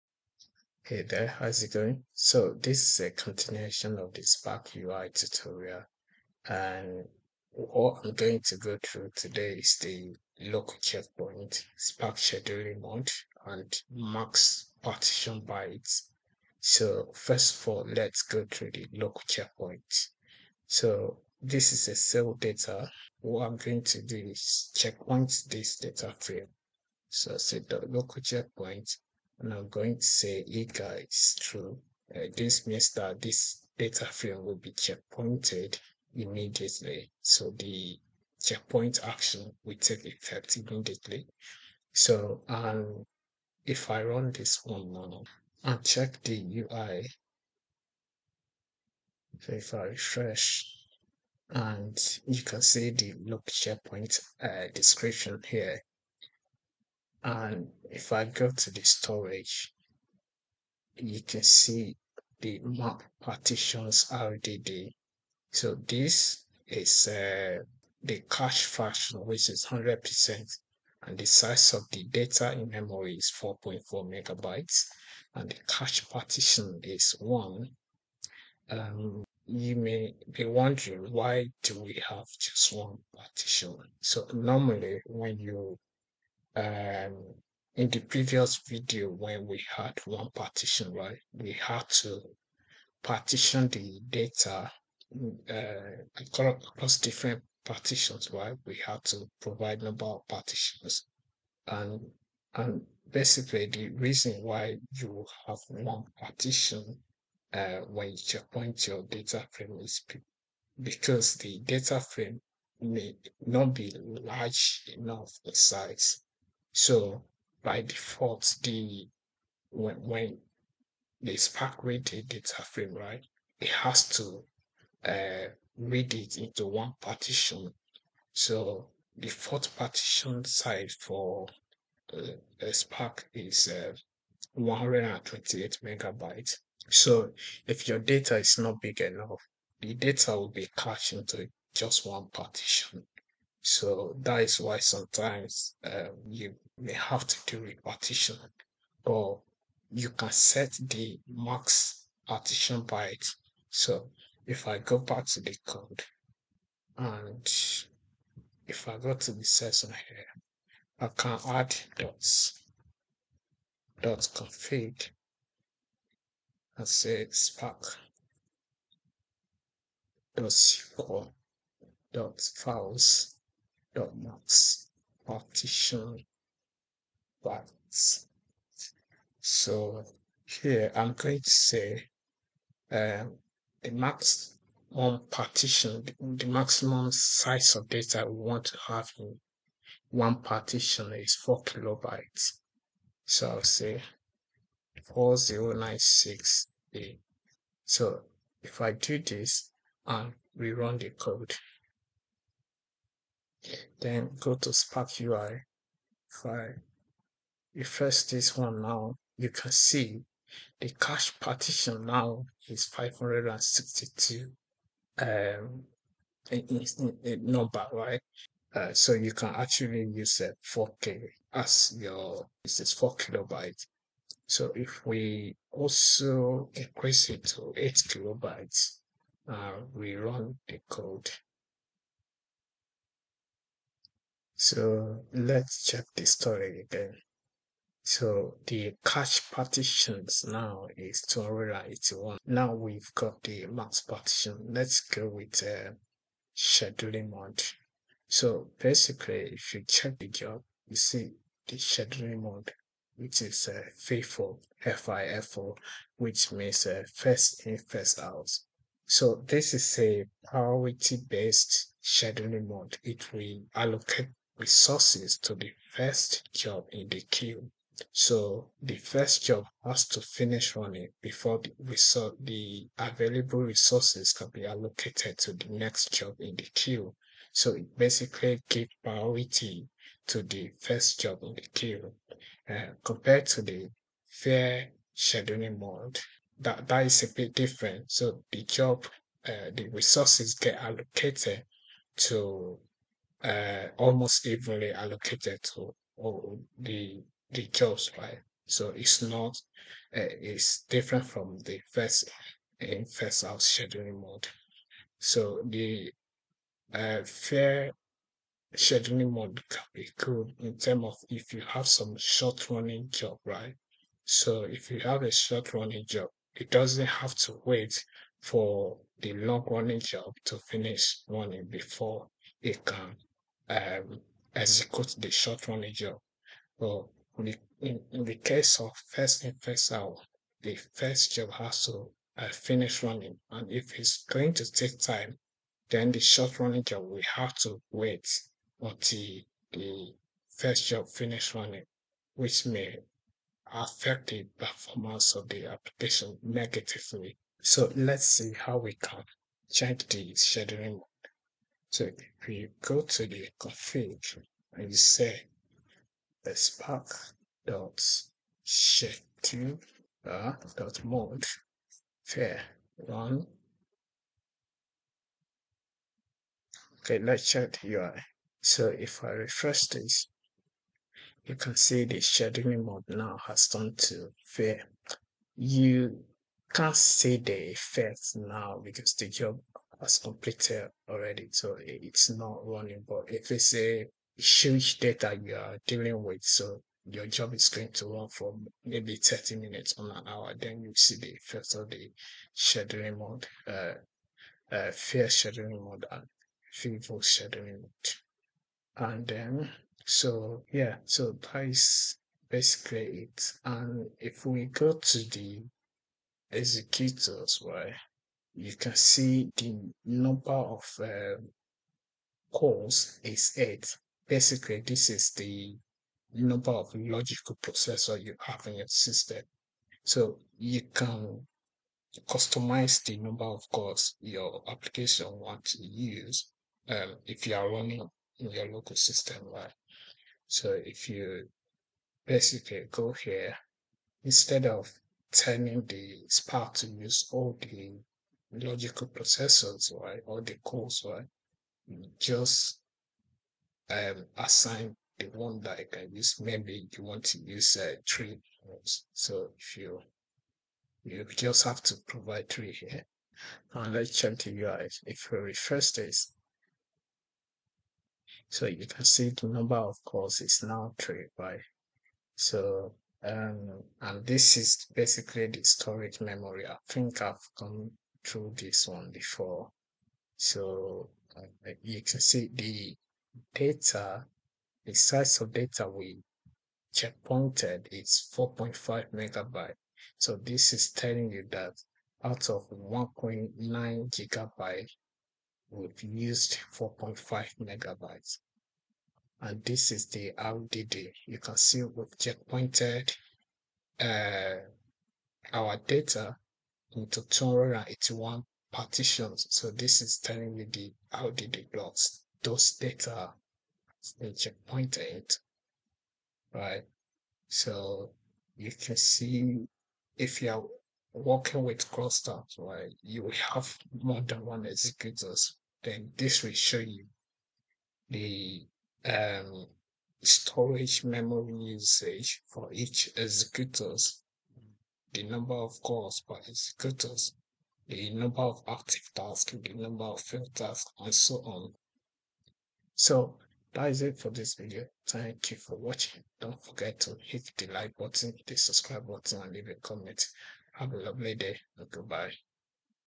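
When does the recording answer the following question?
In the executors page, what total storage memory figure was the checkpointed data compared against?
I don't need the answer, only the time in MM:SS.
08:02.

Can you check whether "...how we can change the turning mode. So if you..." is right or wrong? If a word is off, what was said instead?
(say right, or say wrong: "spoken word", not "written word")
wrong: "scheduling", not "turning".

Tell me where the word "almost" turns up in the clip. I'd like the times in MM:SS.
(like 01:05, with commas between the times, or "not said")
04:53.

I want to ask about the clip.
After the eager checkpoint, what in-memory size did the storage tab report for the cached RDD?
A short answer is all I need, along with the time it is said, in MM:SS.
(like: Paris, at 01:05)
4.4 megabytes, at 01:13.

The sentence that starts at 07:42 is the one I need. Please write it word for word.
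so um and this is basically the storage memory.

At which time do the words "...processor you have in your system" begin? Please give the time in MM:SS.
06:57.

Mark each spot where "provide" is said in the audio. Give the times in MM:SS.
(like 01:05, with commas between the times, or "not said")
01:39, 07:32.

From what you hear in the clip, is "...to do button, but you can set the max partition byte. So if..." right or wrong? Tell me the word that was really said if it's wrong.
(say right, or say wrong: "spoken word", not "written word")
wrong: "partition", not "button".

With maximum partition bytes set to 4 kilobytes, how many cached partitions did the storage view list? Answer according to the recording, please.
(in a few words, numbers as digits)
562.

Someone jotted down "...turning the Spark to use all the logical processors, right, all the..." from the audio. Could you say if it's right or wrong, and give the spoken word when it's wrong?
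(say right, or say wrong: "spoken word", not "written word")
right.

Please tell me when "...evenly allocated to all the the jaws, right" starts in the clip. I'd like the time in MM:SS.
04:54.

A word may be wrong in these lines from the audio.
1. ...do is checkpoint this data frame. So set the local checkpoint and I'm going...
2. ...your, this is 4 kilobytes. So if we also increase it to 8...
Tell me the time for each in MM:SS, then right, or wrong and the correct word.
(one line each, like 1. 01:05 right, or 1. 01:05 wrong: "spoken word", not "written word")
1. 00:24 right
2. 03:41 right.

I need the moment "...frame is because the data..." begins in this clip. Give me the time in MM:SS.
01:49.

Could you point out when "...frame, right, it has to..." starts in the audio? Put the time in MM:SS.
02:02.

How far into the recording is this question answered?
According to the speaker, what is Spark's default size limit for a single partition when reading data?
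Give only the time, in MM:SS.
02:14.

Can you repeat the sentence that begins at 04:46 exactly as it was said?
That, that is a bit different.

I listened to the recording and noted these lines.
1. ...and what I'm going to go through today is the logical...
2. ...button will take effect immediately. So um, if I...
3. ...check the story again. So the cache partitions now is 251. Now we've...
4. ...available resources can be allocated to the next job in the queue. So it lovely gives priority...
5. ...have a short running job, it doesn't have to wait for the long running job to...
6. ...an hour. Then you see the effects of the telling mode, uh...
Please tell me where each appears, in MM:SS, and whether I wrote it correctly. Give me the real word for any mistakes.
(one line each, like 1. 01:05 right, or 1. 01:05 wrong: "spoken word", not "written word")
1. 00:06 wrong: "local", not "logical"
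2. 00:39 wrong: "action", not "button"
3. 03:55 wrong: "281", not "251"
4. 04:32 wrong: "basically", not "lovely"
5. 05:15 right
6. 06:30 wrong: "scheduling", not "telling".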